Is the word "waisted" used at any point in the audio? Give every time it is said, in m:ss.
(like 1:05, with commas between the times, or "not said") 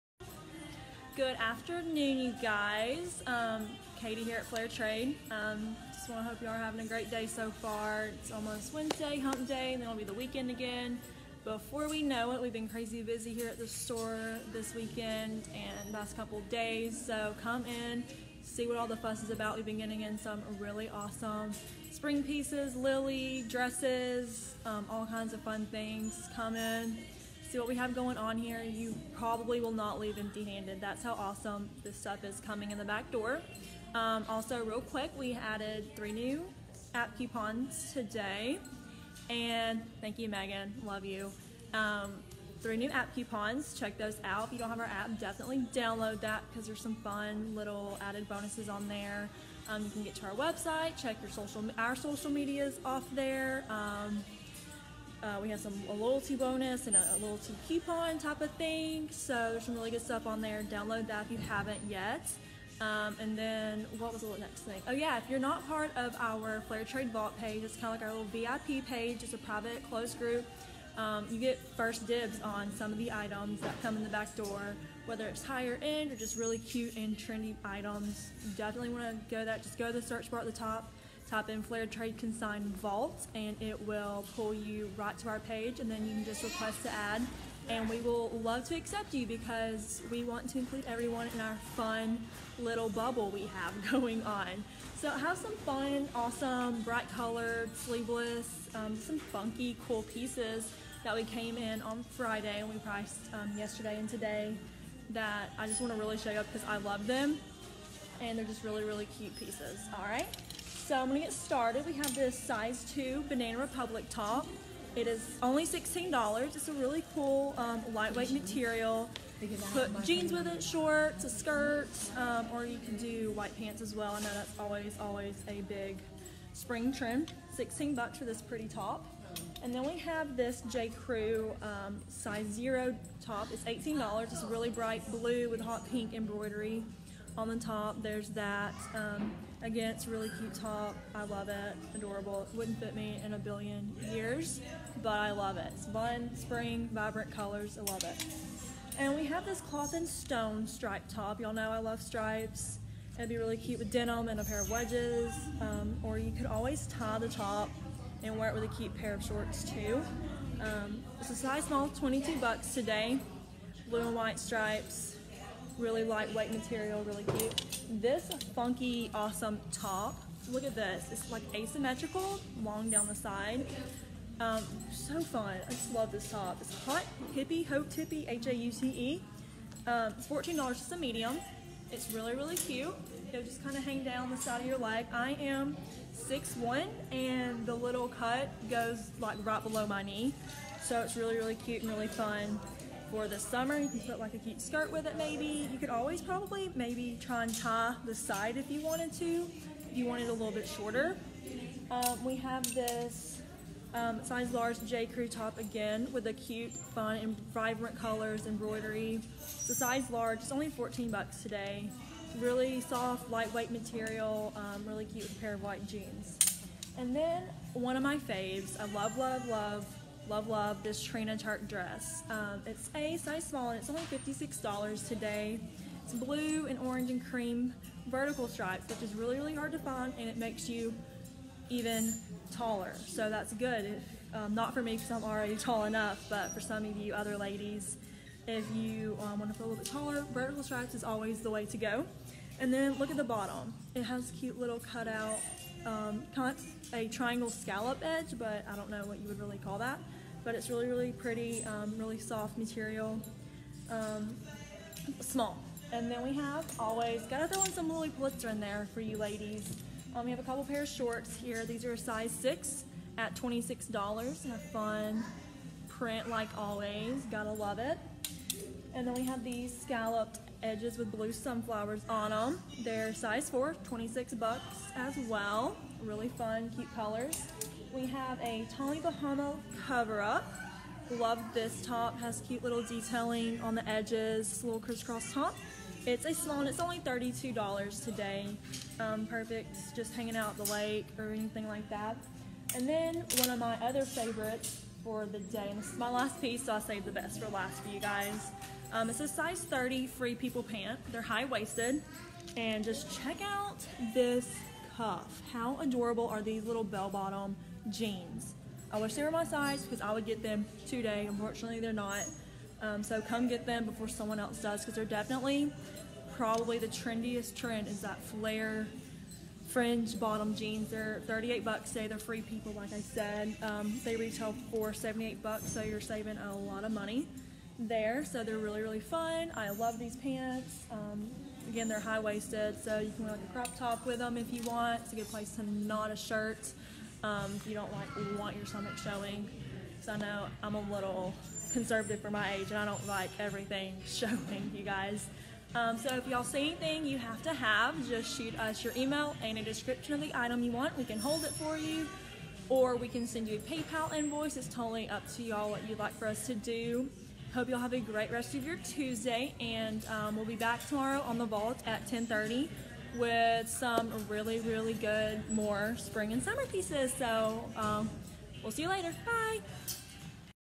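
5:01, 5:32.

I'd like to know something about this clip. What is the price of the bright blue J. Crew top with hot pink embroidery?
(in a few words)
$18.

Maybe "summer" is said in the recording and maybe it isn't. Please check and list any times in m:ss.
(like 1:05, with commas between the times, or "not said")
3:13, 6:06.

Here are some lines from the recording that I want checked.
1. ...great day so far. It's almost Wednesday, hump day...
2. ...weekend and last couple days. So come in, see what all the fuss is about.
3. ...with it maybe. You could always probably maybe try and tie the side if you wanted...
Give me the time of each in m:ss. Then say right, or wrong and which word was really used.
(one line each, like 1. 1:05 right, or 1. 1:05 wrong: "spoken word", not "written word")
1. 0:06 right
2. 0:14 right
3. 3:14 right.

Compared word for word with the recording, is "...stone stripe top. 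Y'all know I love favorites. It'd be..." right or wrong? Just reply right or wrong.
wrong.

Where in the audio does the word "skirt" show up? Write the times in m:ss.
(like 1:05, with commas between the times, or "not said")
2:01, 3:14.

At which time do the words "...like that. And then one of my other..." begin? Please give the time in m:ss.
4:51.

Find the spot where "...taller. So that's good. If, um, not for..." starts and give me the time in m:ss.
3:52.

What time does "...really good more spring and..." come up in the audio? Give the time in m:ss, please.
6:04.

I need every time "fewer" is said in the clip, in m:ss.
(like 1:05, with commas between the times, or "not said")
not said.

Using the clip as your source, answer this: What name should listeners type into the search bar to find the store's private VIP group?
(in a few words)
Flair Trade Consign Vault.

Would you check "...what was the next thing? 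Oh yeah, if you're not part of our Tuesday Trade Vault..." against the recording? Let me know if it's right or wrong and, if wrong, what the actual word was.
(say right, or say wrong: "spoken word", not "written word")
wrong: "Flair", not "Tuesday".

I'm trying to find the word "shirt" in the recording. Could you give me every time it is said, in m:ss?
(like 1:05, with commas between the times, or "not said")
5:36.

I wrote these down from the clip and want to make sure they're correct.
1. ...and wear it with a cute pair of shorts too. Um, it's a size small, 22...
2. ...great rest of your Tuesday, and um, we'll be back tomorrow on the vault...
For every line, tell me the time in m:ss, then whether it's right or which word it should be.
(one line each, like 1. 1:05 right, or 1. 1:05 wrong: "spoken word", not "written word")
1. 2:38 right
2. 5:57 right.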